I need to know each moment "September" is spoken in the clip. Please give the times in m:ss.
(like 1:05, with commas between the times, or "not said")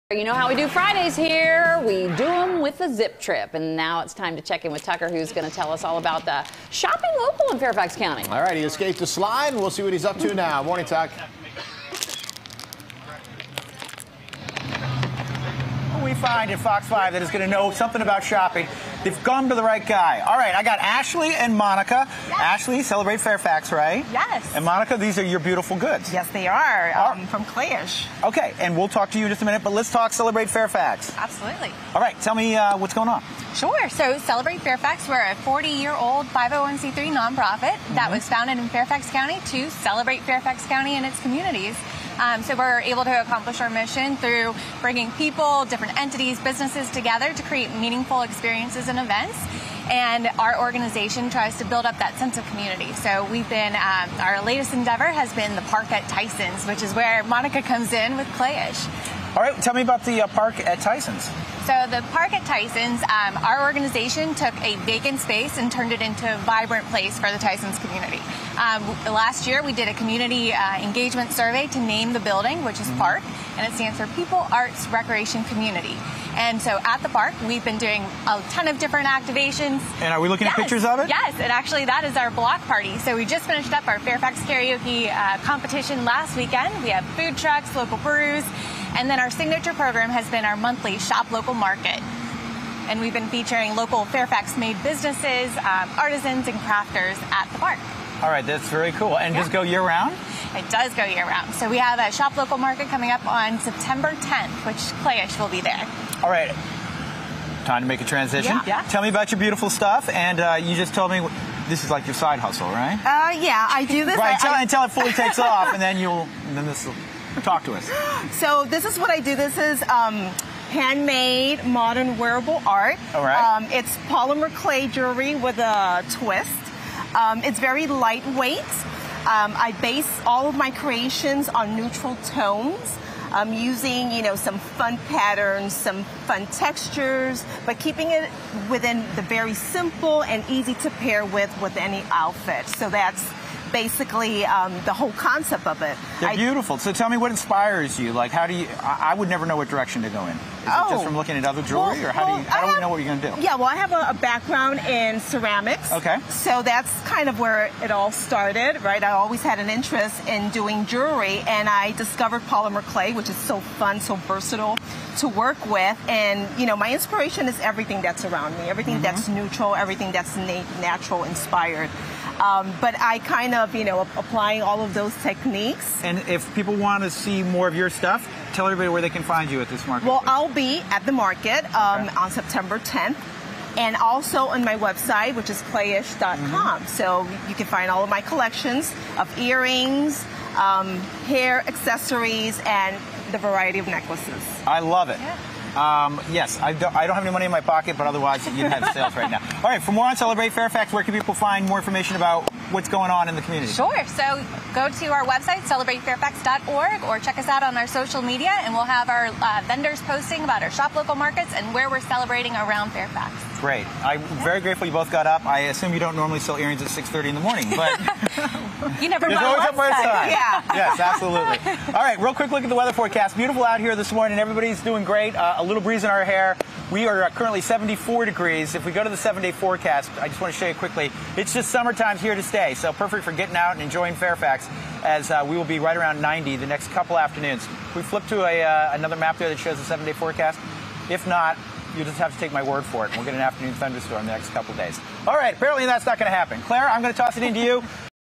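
1:43, 3:02.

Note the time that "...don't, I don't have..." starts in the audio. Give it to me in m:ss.
3:16.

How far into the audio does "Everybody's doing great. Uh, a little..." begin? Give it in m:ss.
3:44.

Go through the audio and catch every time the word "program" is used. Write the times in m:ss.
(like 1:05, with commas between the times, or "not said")
1:29.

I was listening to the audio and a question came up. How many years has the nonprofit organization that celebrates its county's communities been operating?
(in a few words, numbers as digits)
40.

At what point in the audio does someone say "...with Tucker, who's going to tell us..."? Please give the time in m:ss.
0:04.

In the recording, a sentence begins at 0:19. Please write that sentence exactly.
They've gone to the right guy.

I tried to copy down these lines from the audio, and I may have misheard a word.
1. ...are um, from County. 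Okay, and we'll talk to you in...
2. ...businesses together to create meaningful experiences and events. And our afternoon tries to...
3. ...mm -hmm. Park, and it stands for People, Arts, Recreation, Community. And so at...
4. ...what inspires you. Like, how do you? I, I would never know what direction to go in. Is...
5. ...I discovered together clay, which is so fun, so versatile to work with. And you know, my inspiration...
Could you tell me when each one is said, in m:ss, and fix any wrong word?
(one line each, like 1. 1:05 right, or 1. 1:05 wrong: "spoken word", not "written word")
1. 0:26 wrong: "Klayish", not "County"
2. 0:46 wrong: "organization", not "afternoon"
3. 1:12 right
4. 2:27 right
5. 2:41 wrong: "polymer", not "together".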